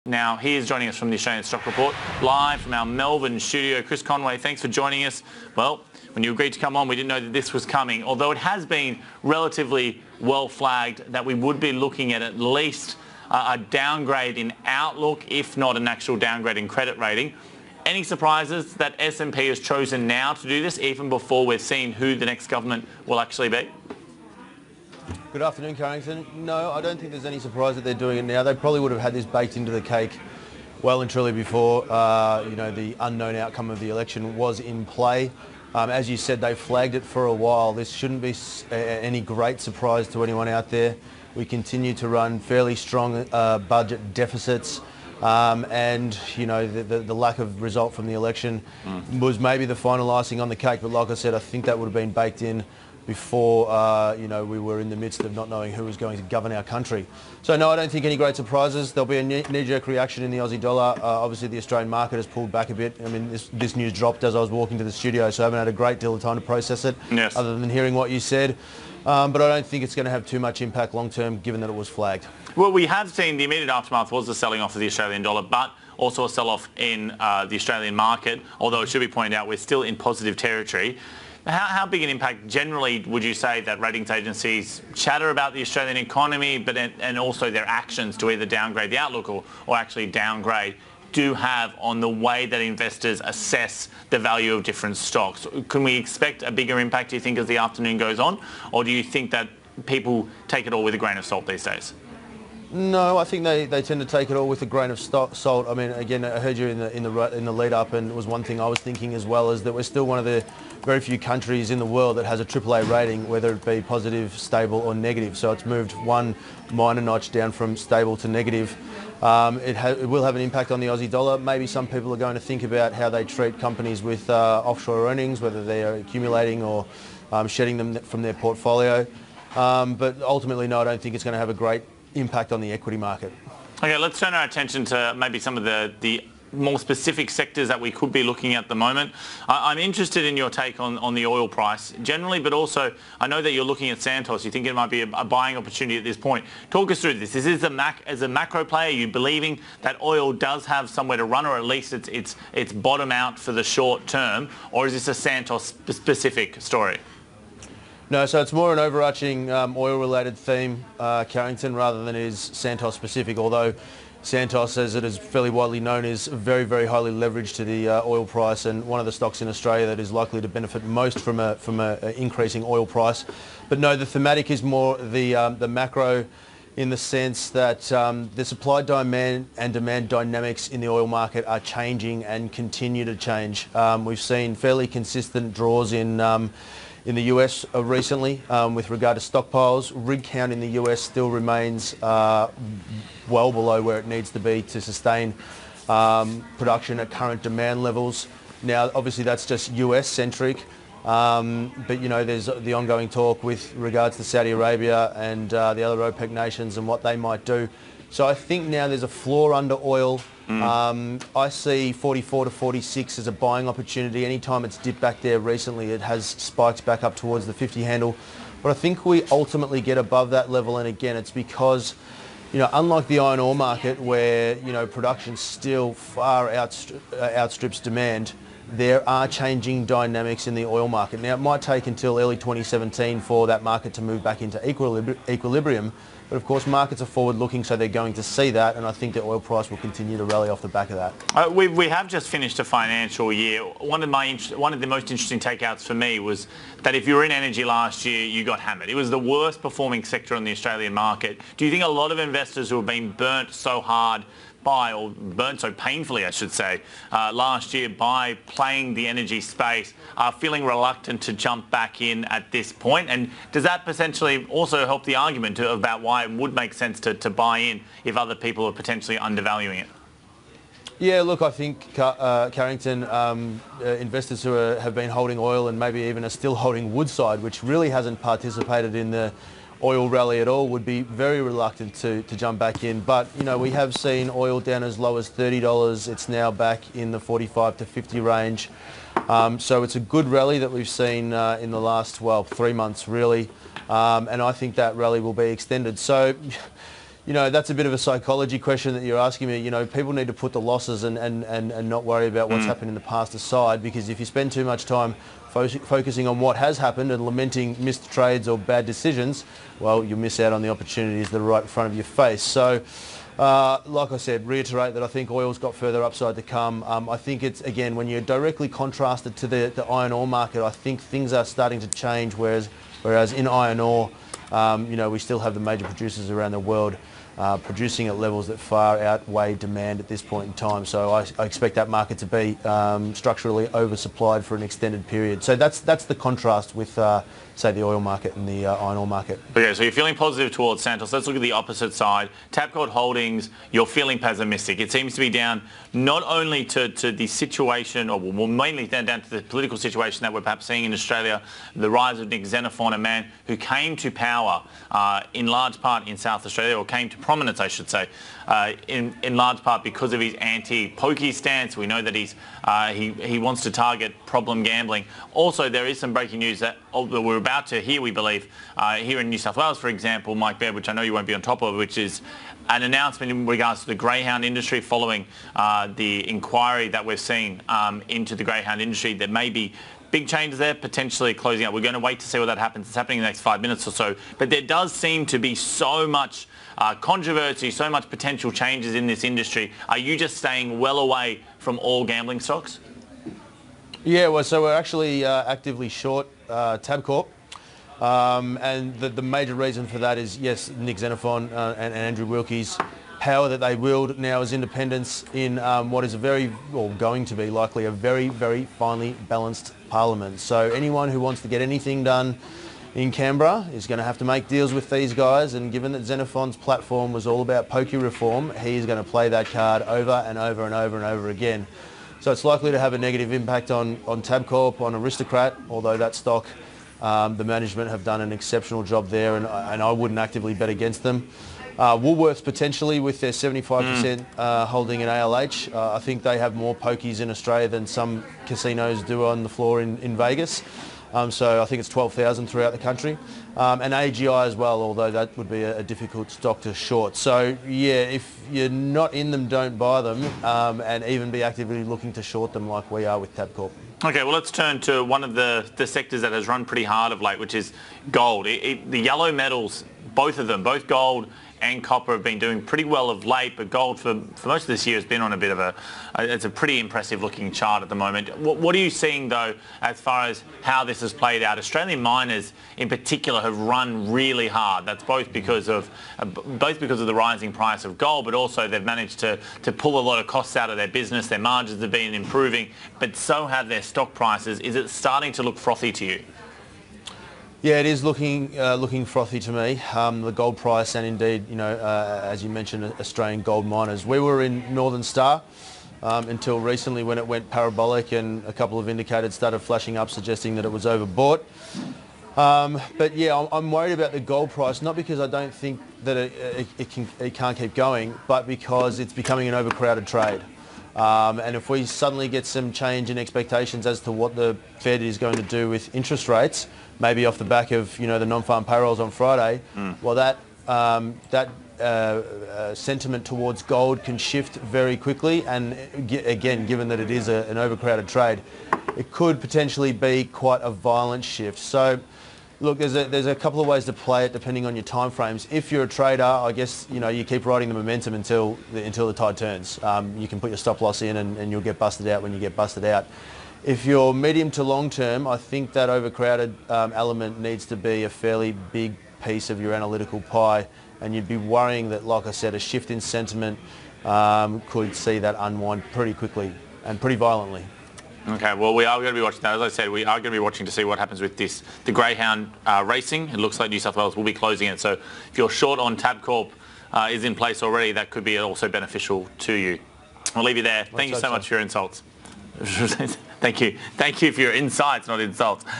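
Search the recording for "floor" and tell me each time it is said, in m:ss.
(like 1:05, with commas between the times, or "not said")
3:29, 7:19.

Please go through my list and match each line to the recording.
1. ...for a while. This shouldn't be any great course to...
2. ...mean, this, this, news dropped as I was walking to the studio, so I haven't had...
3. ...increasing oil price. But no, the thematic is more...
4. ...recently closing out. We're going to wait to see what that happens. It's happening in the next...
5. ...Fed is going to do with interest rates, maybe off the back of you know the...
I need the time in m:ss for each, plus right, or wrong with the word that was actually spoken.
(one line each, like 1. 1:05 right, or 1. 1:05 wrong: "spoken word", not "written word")
1. 0:37 wrong: "surprise", not "course"
2. 1:03 right
3. 2:52 right
4. 6:20 wrong: "potentially", not "recently"
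5. 8:34 right.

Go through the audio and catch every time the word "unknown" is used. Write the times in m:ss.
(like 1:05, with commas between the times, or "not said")
0:32.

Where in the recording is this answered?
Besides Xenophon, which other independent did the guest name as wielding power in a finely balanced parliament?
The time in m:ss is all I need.
6:42.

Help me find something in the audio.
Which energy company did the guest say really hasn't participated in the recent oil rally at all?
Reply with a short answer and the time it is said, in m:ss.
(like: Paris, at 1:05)
Woodside, at 4:36.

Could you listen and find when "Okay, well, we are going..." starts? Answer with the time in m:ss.
9:18.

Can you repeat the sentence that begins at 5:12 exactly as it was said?
So, uh, like I said, reiterate that I think oil's got further upside to come.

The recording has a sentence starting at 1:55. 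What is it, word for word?
So it's moved one minor notch down from stable to negative.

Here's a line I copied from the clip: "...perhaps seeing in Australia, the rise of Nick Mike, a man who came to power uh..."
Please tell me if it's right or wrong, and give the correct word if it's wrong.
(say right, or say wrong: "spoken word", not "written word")
wrong: "Xenophon", not "Mike".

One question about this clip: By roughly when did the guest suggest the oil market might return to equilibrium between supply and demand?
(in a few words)
early 2017.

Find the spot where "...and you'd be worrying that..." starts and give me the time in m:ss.
9:11.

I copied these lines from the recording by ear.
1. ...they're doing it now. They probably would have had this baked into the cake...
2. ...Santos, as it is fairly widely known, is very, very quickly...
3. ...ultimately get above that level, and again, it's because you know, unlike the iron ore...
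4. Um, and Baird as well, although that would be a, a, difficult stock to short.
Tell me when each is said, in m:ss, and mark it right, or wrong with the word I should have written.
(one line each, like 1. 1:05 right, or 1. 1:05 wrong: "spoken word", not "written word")
1. 0:27 right
2. 2:44 wrong: "highly", not "quickly"
3. 3:39 right
4. 7:23 wrong: "AGI", not "Baird".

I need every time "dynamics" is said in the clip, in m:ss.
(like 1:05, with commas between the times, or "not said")
3:00, 3:49.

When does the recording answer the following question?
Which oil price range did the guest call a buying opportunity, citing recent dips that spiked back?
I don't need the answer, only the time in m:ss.
3:31.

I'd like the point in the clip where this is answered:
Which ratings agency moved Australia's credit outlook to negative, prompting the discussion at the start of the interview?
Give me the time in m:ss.
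0:18.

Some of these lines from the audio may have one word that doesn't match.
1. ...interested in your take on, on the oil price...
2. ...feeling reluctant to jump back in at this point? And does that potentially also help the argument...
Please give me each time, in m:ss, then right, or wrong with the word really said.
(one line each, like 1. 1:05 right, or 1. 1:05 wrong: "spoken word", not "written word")
1. 2:19 right
2. 4:20 right.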